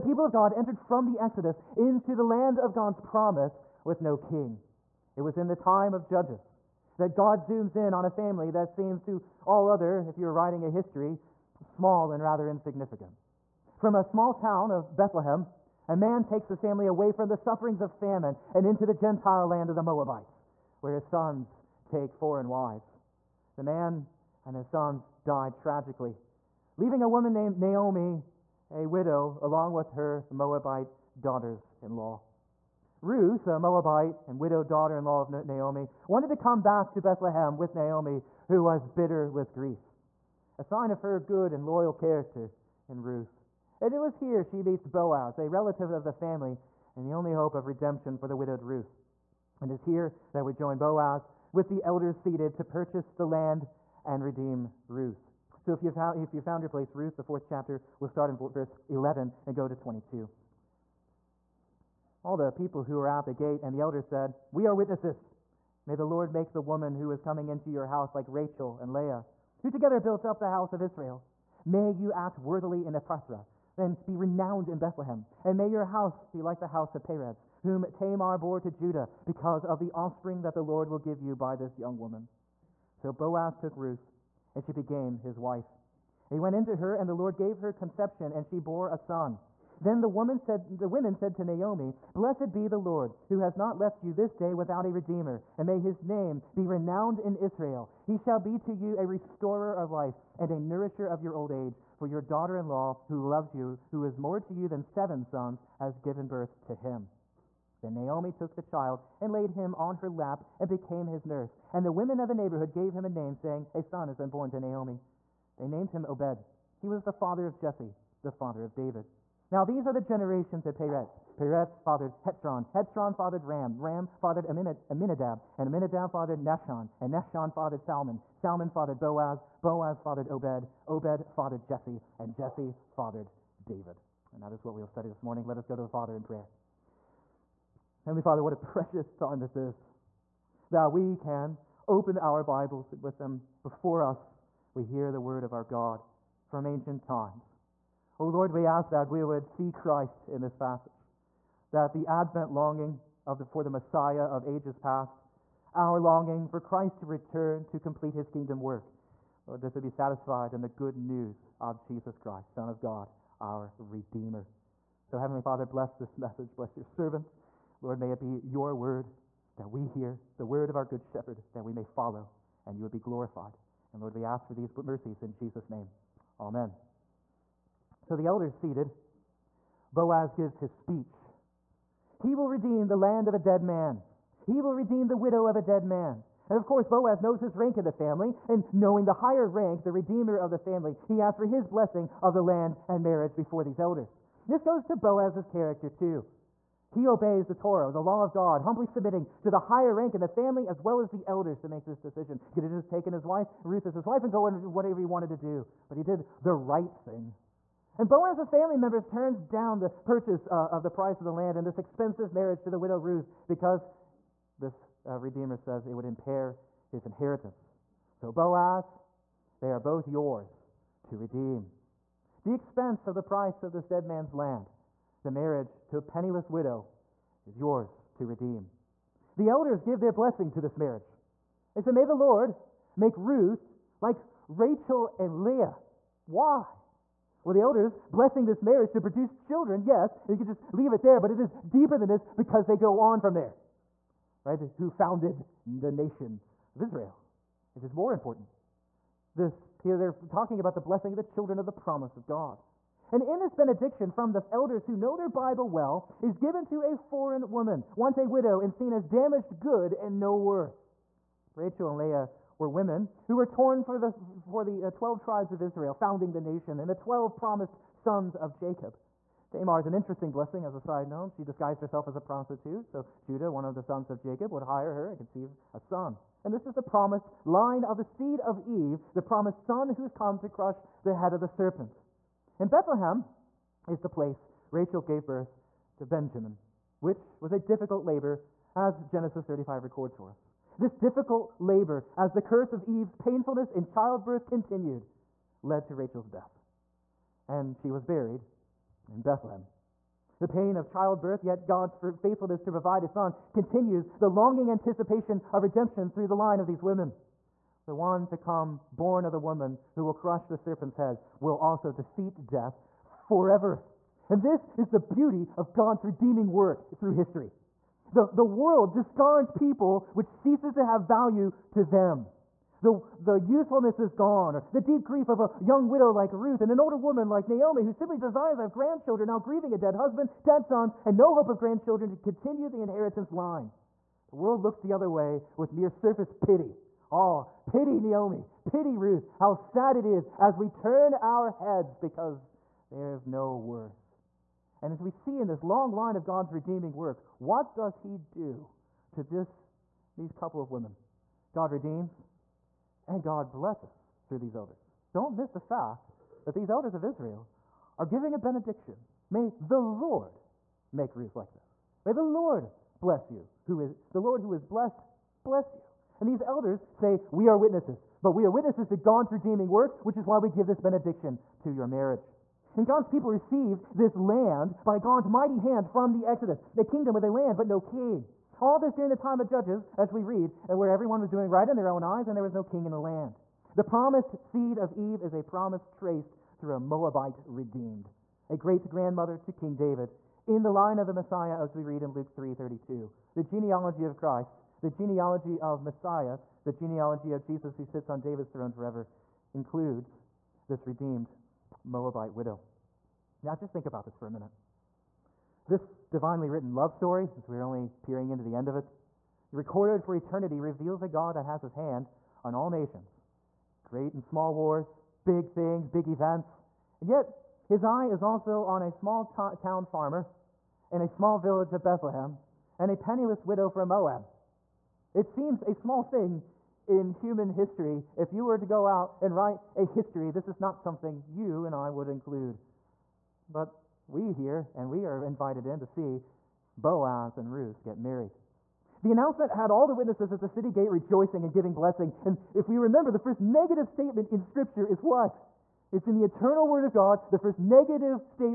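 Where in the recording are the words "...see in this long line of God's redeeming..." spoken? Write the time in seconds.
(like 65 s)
345 s.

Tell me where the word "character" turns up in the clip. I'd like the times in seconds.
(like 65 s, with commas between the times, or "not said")
41 s, 195 s.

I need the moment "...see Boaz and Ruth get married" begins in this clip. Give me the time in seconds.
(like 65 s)
435 s.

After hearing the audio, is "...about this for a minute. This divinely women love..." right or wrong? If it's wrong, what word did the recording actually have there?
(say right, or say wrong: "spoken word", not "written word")
wrong: "written", not "women".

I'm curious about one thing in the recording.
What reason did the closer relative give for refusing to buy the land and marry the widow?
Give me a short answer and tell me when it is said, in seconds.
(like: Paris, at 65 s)
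it would impair his inheritance, at 216 s.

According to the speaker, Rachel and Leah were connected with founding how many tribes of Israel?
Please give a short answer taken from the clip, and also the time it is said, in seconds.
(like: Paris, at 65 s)
12, at 264 s.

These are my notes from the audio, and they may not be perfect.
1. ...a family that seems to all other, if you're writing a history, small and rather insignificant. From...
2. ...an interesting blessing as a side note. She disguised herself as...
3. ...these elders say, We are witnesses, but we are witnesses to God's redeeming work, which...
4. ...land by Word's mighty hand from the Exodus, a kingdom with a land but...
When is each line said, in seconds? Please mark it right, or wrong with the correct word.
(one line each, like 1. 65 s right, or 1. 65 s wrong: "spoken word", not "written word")
1. 8 s right
2. 269 s right
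3. 366 s right
4. 374 s wrong: "God", not "Word".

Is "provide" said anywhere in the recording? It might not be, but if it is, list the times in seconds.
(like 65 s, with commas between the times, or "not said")
302 s.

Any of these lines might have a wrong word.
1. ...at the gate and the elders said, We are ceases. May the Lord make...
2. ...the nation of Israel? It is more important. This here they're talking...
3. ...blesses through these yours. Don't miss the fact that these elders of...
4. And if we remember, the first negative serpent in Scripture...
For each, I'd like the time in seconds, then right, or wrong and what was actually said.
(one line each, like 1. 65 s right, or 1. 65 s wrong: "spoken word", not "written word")
1. 63 s wrong: "witnesses", not "ceases"
2. 245 s right
3. 353 s wrong: "elders", not "yours"
4. 442 s wrong: "statement", not "serpent".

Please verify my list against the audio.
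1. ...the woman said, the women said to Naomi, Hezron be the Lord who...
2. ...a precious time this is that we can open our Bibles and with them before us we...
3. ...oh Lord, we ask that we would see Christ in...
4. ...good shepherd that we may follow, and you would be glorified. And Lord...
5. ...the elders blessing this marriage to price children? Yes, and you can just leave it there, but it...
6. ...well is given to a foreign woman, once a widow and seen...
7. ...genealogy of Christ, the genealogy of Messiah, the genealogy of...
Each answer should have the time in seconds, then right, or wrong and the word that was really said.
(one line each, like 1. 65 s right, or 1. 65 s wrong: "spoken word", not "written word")
1. 90 s wrong: "Blessed", not "Hezron"
2. 138 s right
3. 148 s right
4. 170 s right
5. 237 s wrong: "produce", not "price"
6. 255 s right
7. 393 s right.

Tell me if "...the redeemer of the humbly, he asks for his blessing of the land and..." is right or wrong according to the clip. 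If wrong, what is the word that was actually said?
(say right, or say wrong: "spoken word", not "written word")
wrong: "family", not "humbly".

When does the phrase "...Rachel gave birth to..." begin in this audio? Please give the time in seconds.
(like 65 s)
284 s.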